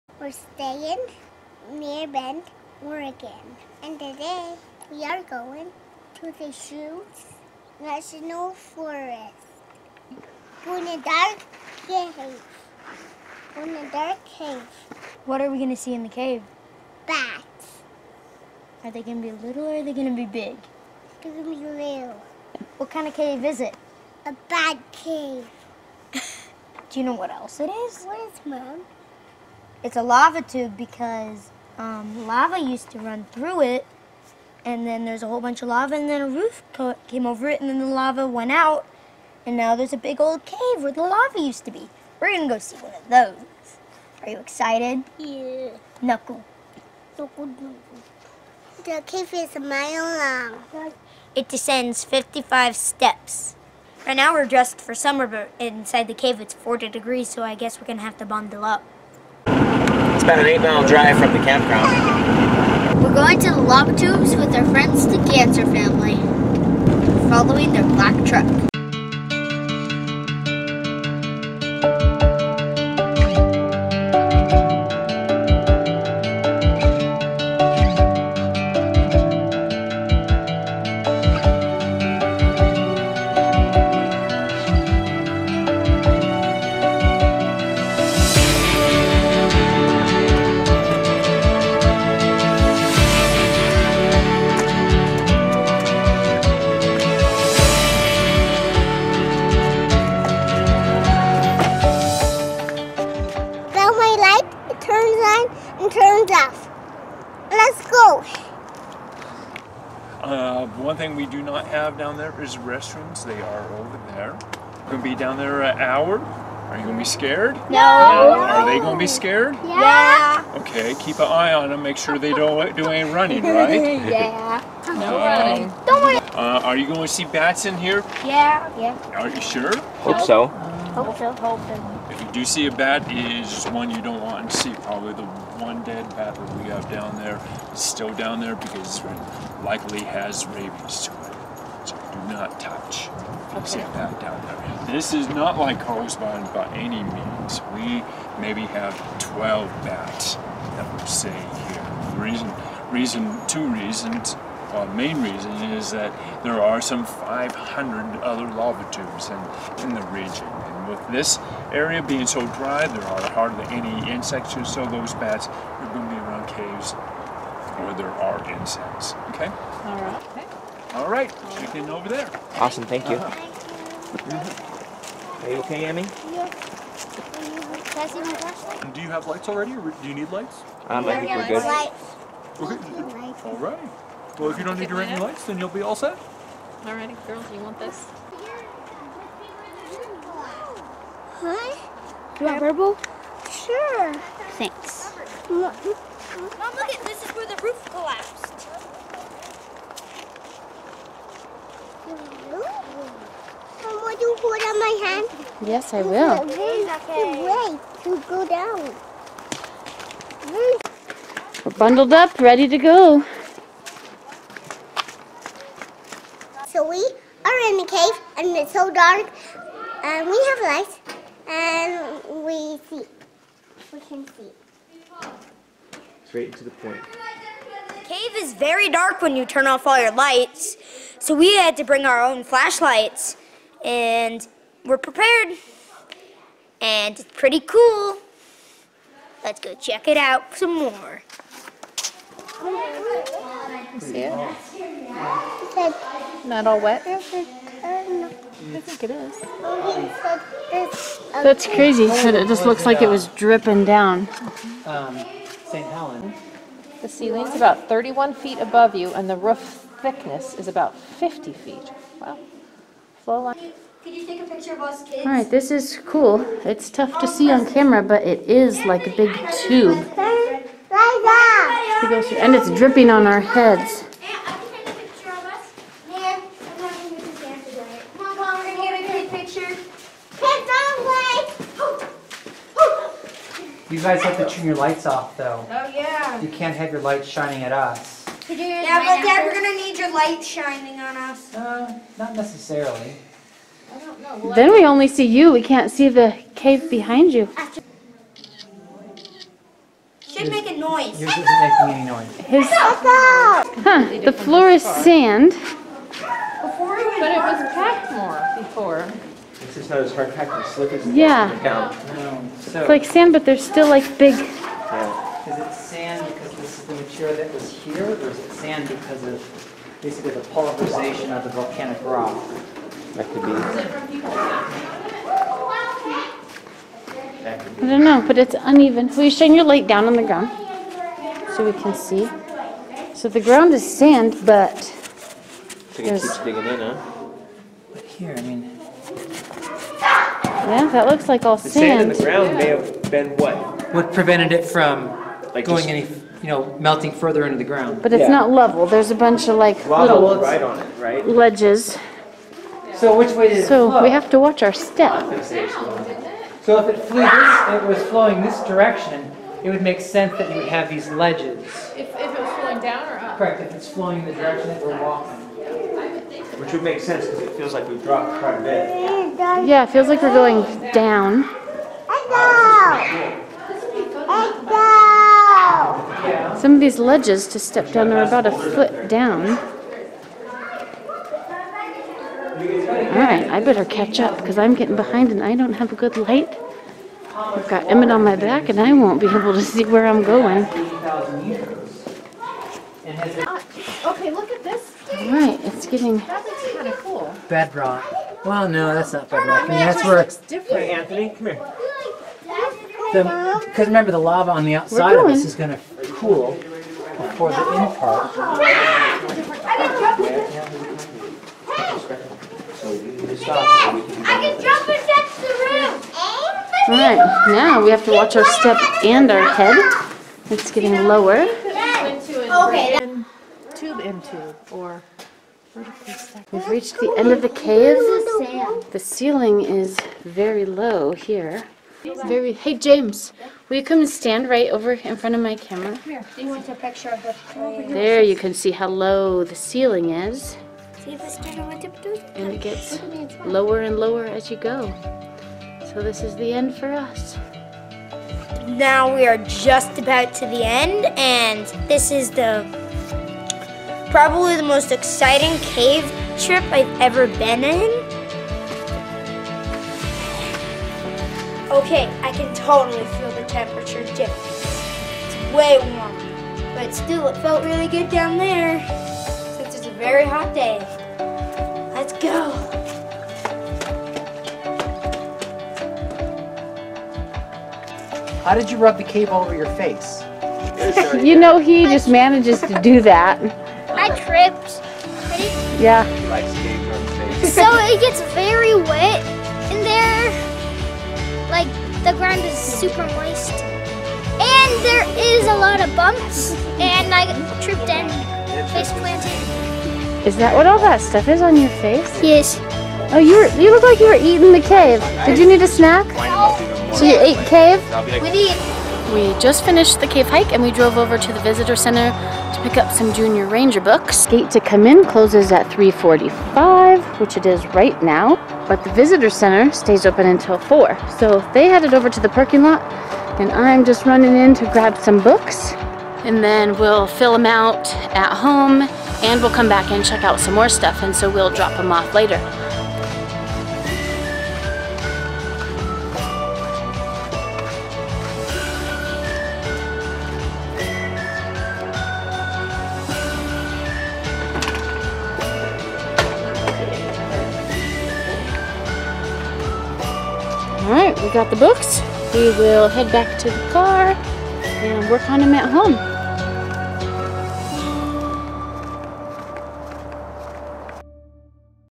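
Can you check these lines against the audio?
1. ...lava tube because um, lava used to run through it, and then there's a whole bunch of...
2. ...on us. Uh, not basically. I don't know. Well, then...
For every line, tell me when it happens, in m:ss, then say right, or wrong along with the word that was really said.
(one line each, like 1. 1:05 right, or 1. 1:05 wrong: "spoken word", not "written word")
1. 0:30 right
2. 4:51 wrong: "necessarily", not "basically".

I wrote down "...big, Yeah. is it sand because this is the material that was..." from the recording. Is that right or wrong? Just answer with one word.
right.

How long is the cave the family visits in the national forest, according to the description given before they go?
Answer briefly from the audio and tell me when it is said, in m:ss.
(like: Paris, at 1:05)
1 mile, at 0:49.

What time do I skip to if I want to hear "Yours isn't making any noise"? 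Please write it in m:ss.
5:01.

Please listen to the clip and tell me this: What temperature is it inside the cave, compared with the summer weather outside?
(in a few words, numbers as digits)
40 degrees.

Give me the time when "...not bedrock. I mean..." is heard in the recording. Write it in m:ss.
6:39.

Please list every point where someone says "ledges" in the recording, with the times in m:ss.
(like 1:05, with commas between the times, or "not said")
5:51, 6:01, 6:16.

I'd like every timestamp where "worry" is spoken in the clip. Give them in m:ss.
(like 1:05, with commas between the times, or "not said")
2:06.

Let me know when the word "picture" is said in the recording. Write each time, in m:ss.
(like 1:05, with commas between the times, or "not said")
4:24, 7:16.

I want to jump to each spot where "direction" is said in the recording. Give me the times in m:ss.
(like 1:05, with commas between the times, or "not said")
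5:58, 6:04.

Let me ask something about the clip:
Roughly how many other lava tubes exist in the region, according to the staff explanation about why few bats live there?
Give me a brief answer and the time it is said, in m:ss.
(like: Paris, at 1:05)
500, at 2:37.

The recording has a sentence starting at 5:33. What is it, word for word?
So the ground is sand, but So it keeps digging in, huh?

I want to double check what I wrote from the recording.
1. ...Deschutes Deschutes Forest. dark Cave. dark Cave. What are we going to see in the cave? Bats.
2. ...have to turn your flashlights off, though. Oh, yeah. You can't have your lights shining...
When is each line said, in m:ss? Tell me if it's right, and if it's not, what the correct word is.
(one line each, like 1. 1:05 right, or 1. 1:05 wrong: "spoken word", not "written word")
1. 0:06 wrong: "National", not "Deschutes"
2. 4:44 wrong: "lights", not "flashlights".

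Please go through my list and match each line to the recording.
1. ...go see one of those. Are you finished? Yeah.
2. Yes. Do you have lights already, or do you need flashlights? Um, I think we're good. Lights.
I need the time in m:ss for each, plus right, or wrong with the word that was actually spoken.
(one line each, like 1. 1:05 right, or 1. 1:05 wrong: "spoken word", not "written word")
1. 0:42 wrong: "excited", not "finished"
2. 2:56 wrong: "lights", not "flashlights".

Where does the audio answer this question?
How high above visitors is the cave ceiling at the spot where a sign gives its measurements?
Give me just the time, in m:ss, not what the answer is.
4:17.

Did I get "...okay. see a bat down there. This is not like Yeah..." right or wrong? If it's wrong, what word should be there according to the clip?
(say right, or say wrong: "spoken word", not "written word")
wrong: "Correspond", not "Yeah".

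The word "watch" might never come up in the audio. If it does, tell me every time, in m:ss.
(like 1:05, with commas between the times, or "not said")
5:54, 6:58.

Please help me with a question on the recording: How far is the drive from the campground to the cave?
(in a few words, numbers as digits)
8 miles.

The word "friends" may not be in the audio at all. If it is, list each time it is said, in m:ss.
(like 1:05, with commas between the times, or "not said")
1:04.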